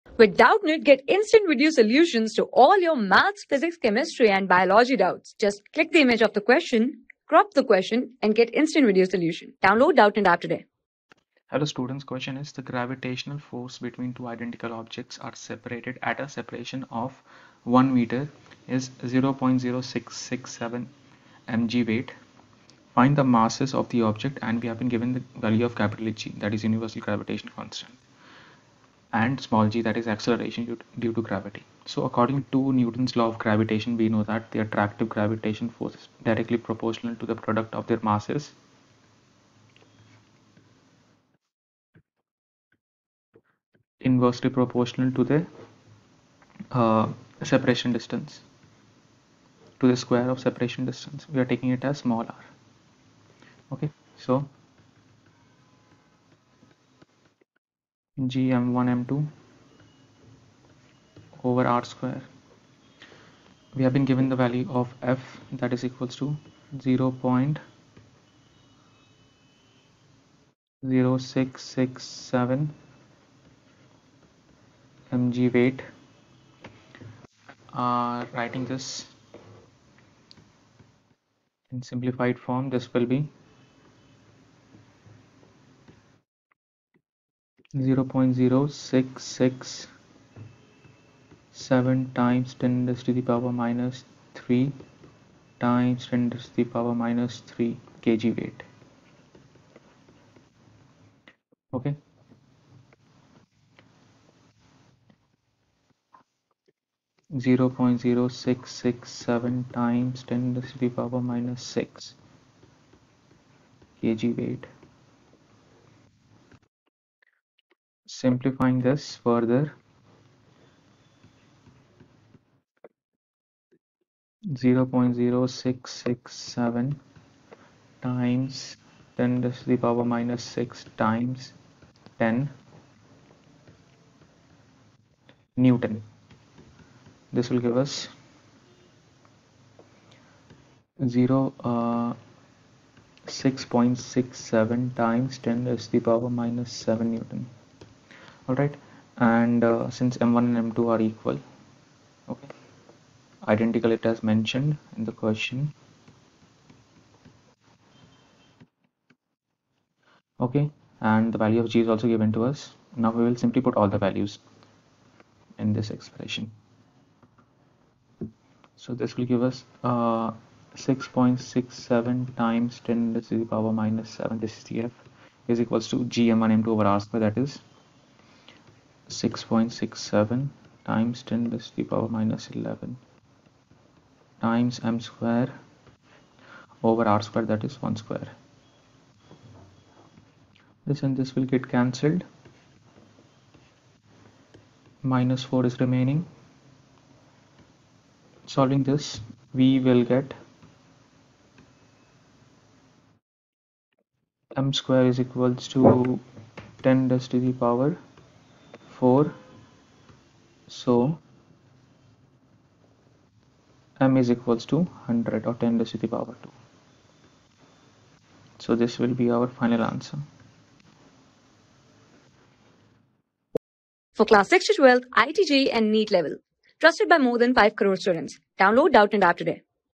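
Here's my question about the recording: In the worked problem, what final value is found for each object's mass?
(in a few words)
100.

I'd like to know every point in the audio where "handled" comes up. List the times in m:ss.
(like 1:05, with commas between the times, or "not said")
not said.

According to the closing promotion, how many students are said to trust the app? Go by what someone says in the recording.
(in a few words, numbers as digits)
more than 5 crore.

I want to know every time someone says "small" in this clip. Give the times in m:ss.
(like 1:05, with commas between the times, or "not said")
0:29, 0:51.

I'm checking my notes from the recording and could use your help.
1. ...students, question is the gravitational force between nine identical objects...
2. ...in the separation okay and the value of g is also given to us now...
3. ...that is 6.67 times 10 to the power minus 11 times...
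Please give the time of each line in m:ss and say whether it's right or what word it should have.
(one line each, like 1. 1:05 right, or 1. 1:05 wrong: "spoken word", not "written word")
1. 0:11 wrong: "two", not "nine"
2. 2:34 wrong: "question", not "separation"
3. 2:57 right.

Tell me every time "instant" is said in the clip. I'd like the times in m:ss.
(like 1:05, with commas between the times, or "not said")
0:01, 0:08.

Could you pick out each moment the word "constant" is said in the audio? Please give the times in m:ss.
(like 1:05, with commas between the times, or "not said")
0:27.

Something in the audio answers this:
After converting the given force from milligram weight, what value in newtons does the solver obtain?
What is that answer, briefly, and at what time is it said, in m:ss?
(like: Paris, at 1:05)
6.67 × 10^-7 newton, at 2:23.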